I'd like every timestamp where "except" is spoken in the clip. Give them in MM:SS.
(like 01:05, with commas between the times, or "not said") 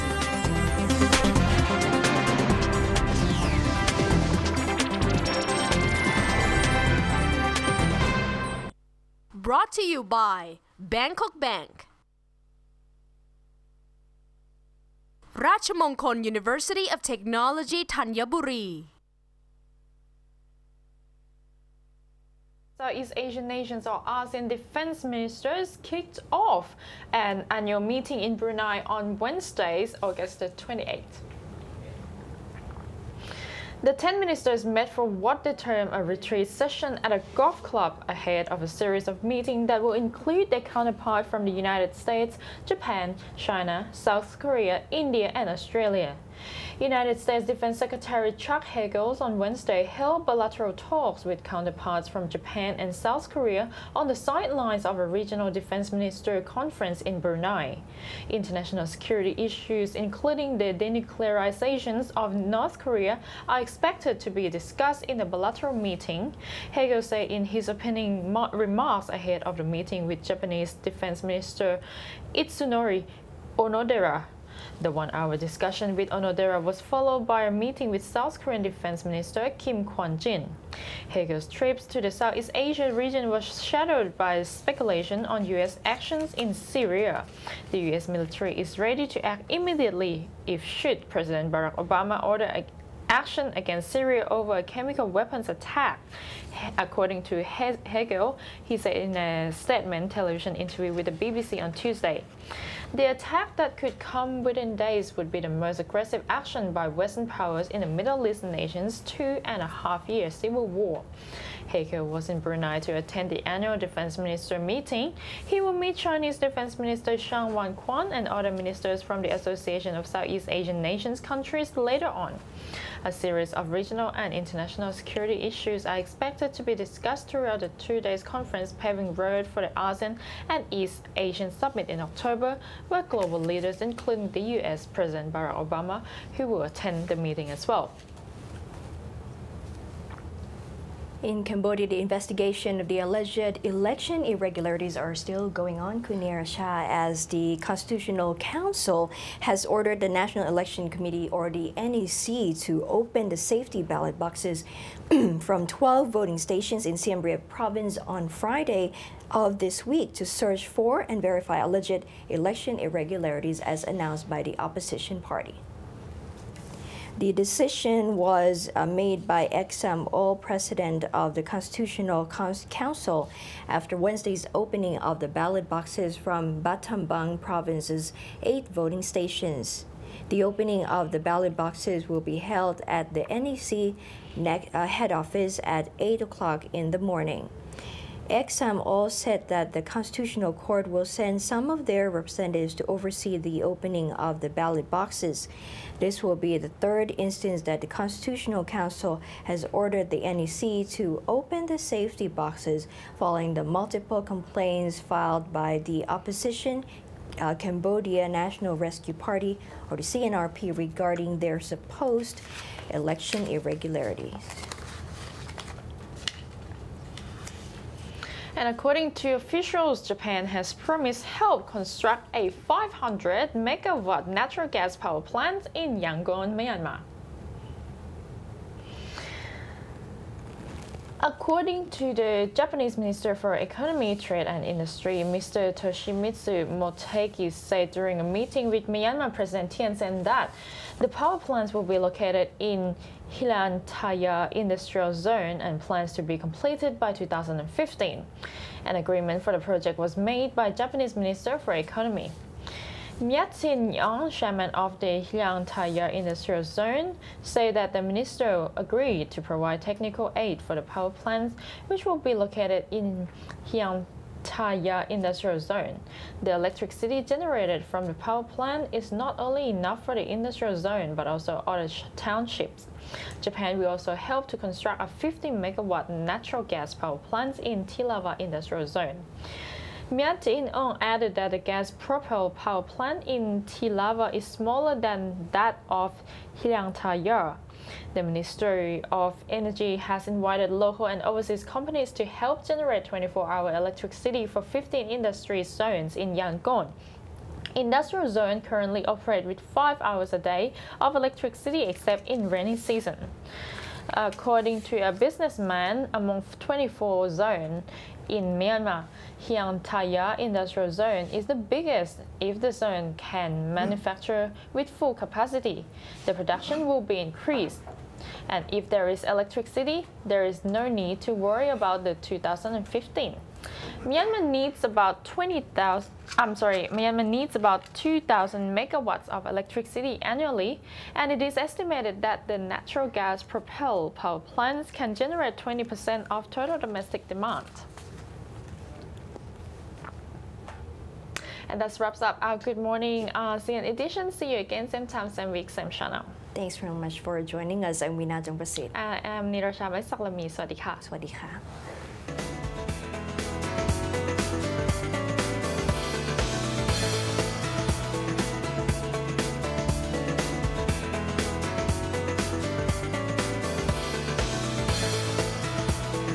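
05:01.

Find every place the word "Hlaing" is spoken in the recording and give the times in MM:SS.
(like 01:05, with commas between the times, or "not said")
04:03, 04:15, 04:23, 04:46, 05:09.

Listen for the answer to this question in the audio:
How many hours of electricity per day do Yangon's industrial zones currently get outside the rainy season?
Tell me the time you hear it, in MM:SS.
04:59.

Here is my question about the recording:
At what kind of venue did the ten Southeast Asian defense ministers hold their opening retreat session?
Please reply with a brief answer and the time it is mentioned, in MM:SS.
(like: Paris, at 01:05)
golf club, at 00:37.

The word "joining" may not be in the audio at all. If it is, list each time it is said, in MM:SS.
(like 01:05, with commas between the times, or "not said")
05:47.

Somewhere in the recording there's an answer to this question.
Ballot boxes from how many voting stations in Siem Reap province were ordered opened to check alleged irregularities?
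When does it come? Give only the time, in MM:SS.
02:35.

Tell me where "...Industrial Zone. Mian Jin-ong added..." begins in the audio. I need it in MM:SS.
04:38.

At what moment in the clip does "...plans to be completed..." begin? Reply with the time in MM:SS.
04:05.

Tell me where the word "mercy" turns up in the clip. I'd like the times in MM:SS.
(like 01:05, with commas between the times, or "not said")
not said.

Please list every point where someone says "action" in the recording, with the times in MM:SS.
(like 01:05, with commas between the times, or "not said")
01:25, 01:33, 01:46.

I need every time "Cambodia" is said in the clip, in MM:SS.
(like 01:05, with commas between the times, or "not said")
02:21, 03:27.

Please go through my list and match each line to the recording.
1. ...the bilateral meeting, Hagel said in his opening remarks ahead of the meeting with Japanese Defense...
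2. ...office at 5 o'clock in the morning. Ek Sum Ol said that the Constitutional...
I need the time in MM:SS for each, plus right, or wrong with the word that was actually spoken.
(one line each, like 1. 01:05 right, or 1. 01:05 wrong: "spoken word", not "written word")
1. 01:05 right
2. 03:05 wrong: "8", not "5".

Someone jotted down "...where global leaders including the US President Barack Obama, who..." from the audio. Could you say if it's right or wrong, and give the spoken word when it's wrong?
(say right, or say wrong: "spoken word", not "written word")
right.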